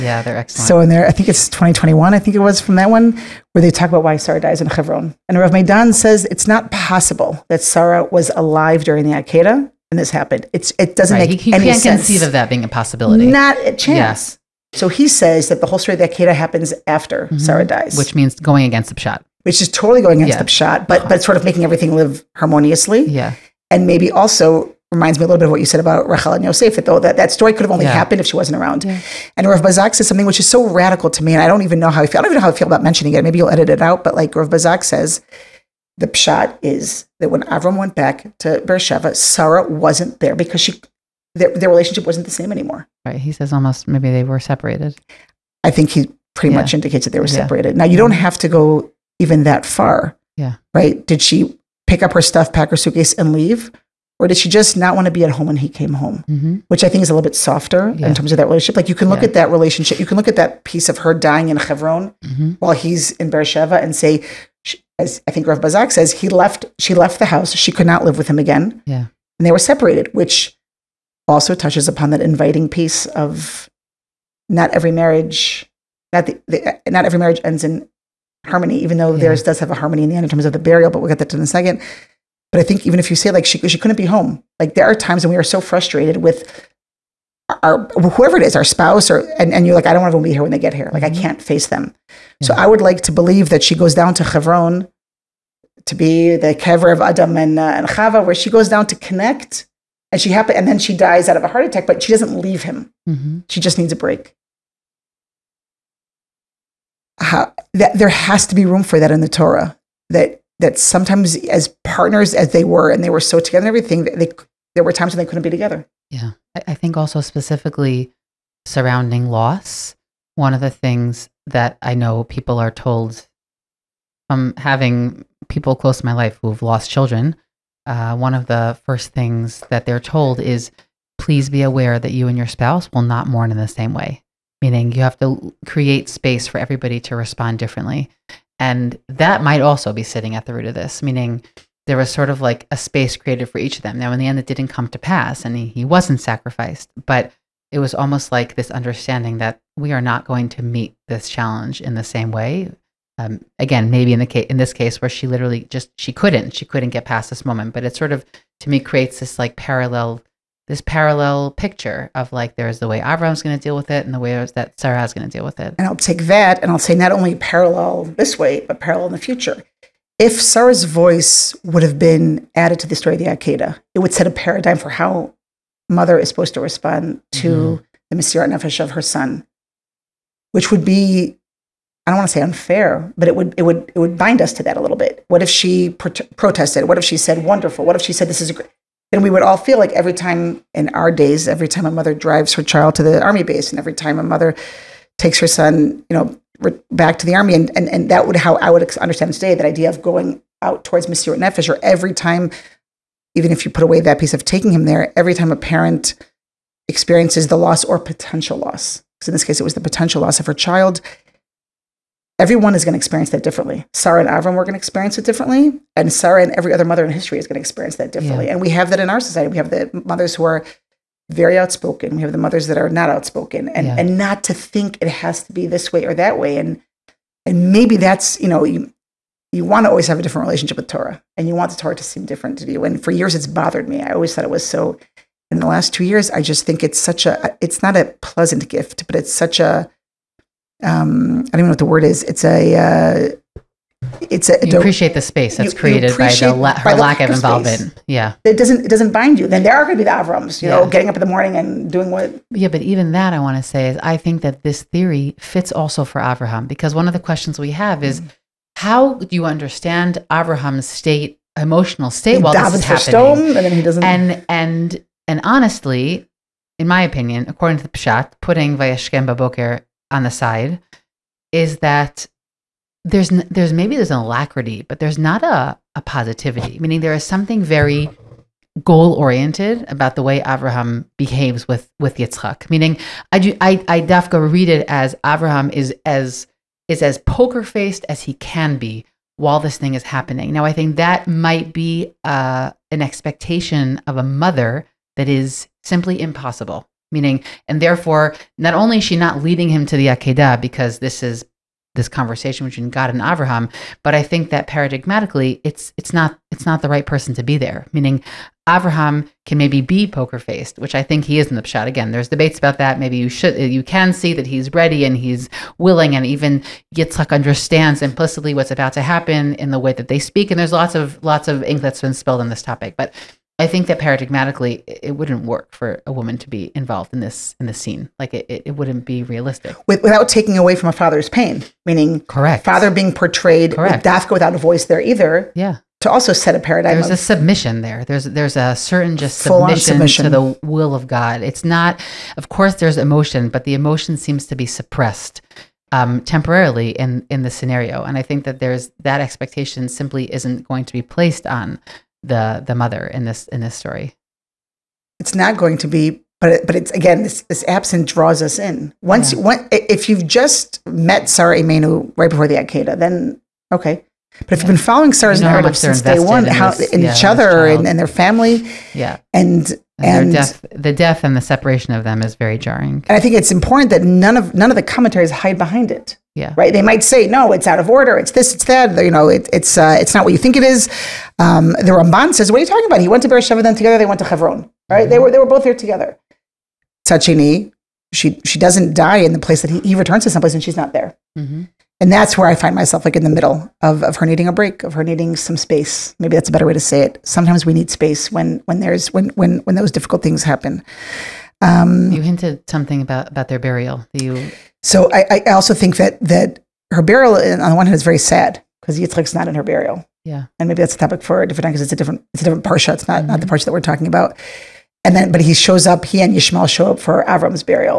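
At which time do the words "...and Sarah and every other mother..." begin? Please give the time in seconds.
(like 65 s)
215 s.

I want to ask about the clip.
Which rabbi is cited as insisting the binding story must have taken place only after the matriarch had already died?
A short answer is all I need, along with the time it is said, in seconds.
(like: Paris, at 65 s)
Rav Medan, at 5 s.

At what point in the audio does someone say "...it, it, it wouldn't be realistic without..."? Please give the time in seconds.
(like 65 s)
328 s.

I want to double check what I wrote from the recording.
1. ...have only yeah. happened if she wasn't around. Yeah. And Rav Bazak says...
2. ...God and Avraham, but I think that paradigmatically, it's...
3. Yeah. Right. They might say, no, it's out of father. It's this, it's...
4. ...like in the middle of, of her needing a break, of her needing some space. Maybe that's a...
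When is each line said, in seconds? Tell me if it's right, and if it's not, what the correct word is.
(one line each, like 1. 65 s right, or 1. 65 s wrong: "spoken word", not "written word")
1. 27 s right
2. 302 s right
3. 376 s wrong: "order", not "father"
4. 393 s right.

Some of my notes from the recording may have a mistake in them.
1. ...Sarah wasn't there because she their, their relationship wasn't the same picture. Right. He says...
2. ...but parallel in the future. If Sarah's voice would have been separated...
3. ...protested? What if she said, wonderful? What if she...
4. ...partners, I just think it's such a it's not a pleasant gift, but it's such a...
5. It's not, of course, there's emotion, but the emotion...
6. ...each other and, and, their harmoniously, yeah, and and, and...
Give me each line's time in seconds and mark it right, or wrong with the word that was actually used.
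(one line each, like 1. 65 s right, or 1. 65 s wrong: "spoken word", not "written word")
1. 39 s wrong: "anymore", not "picture"
2. 168 s wrong: "added", not "separated"
3. 186 s right
4. 236 s wrong: "years", not "partners"
5. 341 s right
6. 367 s wrong: "family", not "harmoniously".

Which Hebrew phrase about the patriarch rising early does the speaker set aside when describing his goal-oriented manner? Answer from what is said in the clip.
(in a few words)
Vayeshkem Baboker.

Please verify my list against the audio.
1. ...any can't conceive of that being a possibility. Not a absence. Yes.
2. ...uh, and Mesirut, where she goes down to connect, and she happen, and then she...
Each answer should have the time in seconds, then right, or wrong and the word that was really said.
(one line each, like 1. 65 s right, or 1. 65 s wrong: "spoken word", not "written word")
1. 11 s wrong: "chance", not "absence"
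2. 97 s wrong: "Chava", not "Mesirut".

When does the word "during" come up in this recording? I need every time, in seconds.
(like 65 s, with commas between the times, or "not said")
8 s.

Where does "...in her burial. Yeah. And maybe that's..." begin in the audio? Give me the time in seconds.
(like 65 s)
409 s.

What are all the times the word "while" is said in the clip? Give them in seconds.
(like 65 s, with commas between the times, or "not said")
62 s, 262 s, 289 s.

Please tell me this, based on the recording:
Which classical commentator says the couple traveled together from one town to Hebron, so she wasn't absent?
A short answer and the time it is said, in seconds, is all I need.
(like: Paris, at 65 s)
Ramban, at 381 s.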